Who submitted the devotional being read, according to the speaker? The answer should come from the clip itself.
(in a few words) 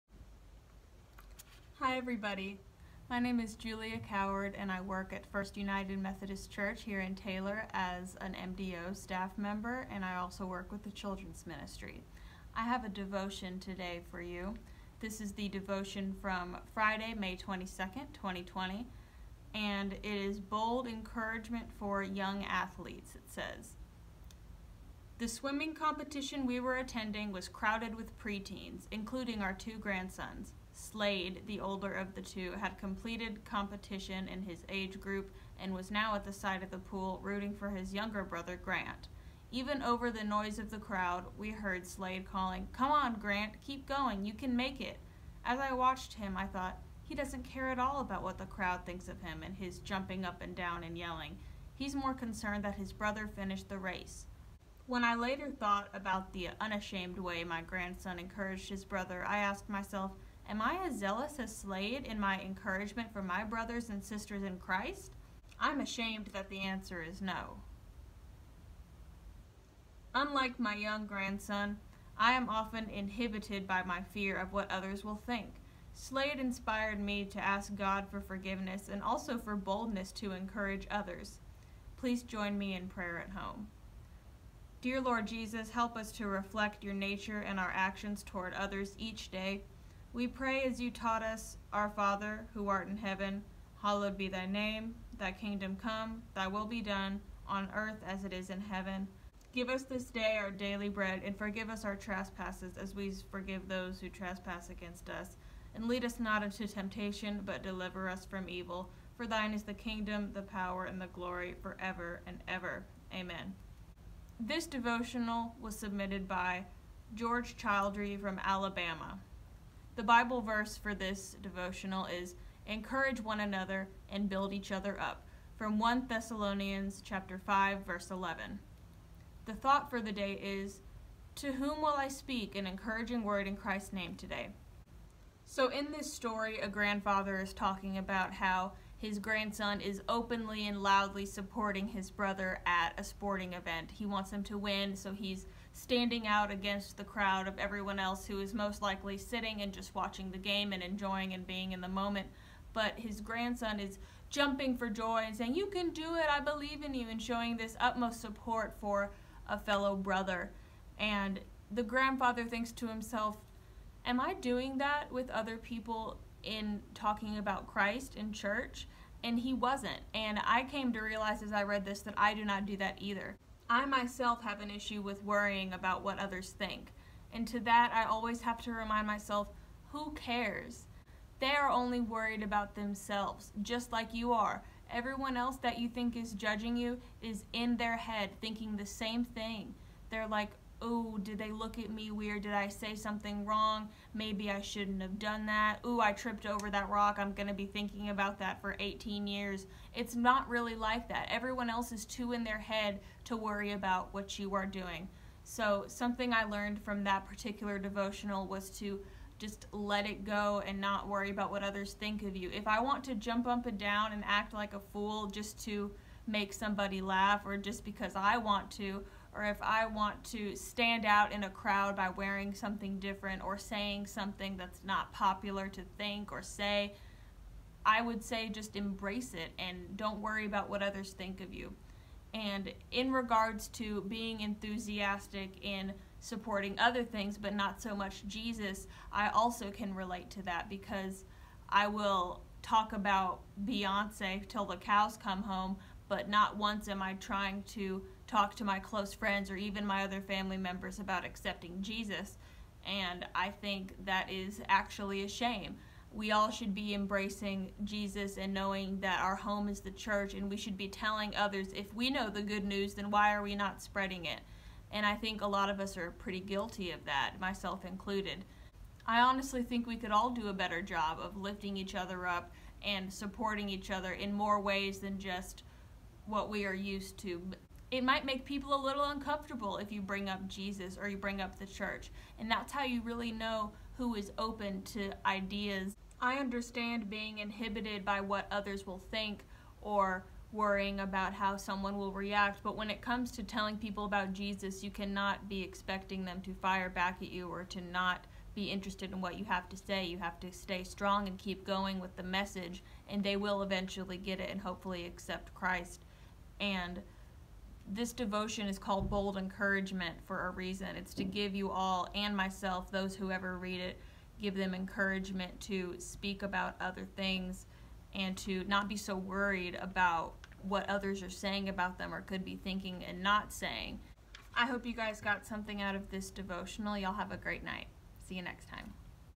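George Childrey.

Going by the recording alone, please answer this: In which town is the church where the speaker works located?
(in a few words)
Taylor.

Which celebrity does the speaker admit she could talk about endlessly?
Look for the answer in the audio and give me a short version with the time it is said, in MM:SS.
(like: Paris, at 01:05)
Beyonce, at 04:03.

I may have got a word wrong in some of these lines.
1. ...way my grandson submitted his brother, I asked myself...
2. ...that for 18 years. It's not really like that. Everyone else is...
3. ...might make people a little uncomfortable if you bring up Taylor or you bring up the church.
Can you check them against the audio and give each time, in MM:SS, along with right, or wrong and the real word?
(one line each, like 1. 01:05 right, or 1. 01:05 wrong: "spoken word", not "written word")
1. 00:57 wrong: "encouraged", not "submitted"
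2. 03:18 right
3. 04:38 wrong: "Jesus", not "Taylor".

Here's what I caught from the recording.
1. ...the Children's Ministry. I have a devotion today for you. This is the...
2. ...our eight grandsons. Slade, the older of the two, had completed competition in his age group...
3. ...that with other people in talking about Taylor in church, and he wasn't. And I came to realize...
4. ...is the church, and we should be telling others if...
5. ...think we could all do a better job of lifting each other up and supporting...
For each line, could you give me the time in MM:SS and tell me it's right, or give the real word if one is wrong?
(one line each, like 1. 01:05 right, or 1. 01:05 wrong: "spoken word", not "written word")
1. 00:10 right
2. 00:29 wrong: "two", not "eight"
3. 02:44 wrong: "Christ", not "Taylor"
4. 04:19 right
5. 04:29 right.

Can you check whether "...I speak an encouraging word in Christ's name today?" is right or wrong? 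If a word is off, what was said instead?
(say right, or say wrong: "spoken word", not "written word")
right.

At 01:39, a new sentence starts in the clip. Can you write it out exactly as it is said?
Give us this day our daily bread, and forgive us our trespasses, as we forgive those who trespass against us.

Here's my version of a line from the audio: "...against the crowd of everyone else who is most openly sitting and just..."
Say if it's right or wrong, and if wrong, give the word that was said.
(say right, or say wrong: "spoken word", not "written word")
wrong: "likely", not "openly".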